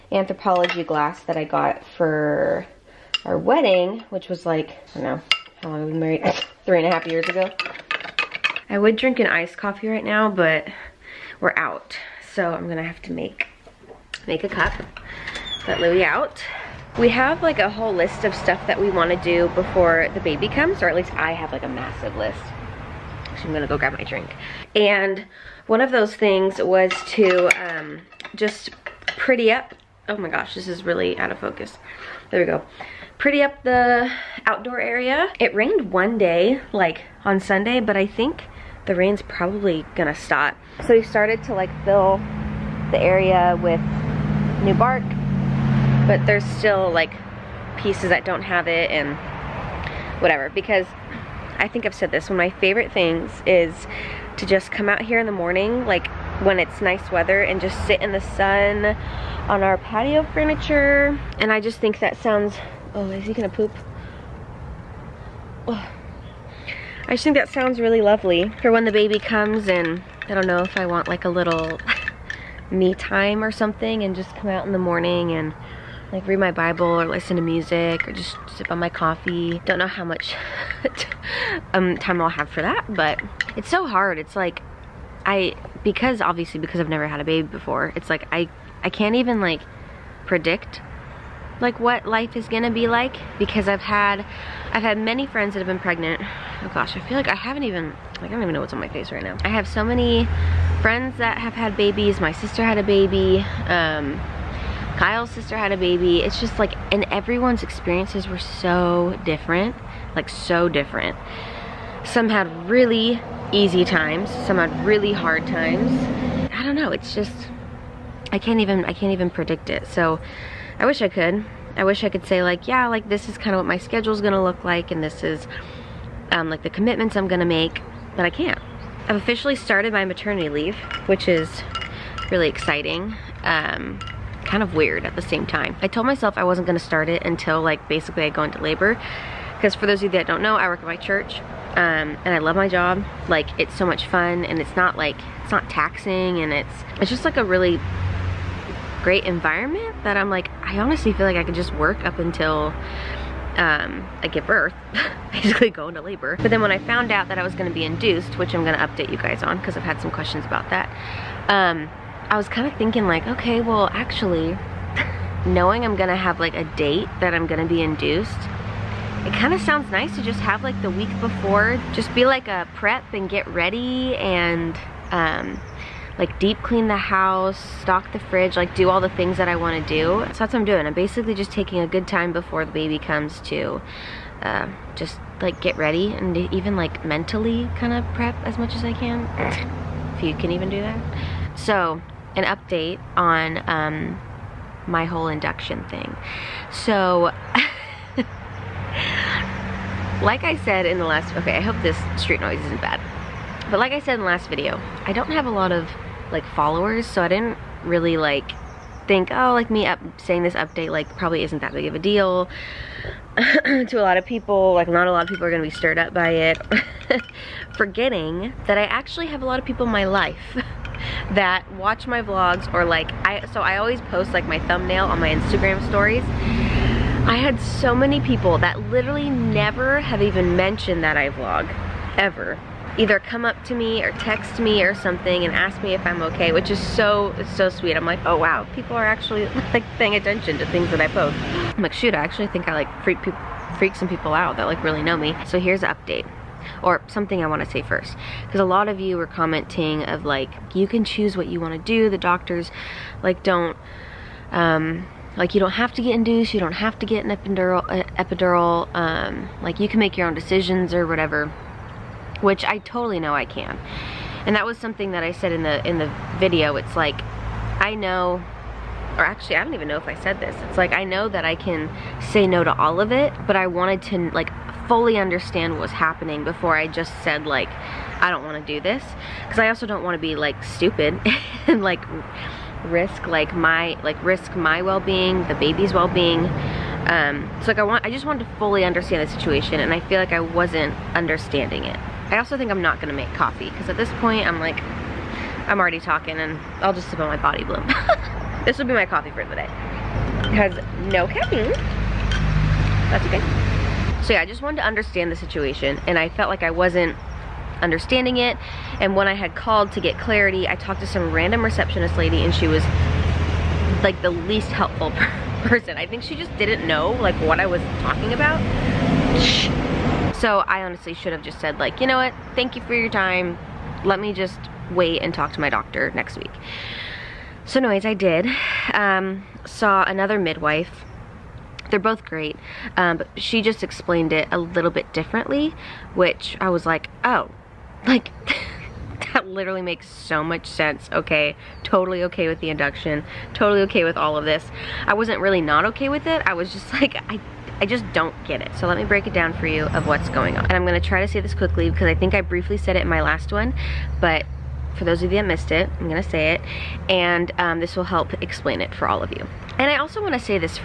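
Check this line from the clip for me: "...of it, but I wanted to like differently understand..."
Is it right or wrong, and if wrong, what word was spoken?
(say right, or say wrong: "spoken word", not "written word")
wrong: "fully", not "differently".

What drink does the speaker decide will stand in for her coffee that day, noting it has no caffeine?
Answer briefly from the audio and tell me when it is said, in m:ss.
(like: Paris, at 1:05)
Body Bloom, at 4:57.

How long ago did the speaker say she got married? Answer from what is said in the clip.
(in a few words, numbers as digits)
3 and a half years.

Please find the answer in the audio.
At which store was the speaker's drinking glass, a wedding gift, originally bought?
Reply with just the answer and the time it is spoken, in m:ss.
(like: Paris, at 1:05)
Anthropologie, at 0:00.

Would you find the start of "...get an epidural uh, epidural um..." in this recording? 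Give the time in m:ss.
4:17.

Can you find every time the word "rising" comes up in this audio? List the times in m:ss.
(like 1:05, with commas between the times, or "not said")
not said.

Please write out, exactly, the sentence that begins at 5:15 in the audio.
I think she just didn't know like what I was talking about.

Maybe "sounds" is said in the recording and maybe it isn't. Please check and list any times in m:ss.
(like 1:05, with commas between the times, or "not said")
1:02, 1:07, 2:49.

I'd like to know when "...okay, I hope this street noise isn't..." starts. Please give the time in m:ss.
3:21.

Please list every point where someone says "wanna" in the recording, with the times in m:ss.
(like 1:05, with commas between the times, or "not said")
0:18, 2:59, 6:00.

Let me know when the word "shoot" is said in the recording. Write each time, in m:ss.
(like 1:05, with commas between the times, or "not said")
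4:01.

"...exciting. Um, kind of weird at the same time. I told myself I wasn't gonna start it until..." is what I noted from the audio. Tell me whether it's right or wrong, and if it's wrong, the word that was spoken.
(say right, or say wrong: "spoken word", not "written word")
right.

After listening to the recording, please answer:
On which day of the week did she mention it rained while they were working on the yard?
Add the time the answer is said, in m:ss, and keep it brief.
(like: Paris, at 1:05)
Sunday, at 0:37.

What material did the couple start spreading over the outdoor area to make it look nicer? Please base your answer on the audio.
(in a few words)
bark.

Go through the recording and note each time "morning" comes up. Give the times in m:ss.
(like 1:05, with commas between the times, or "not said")
0:55, 1:14.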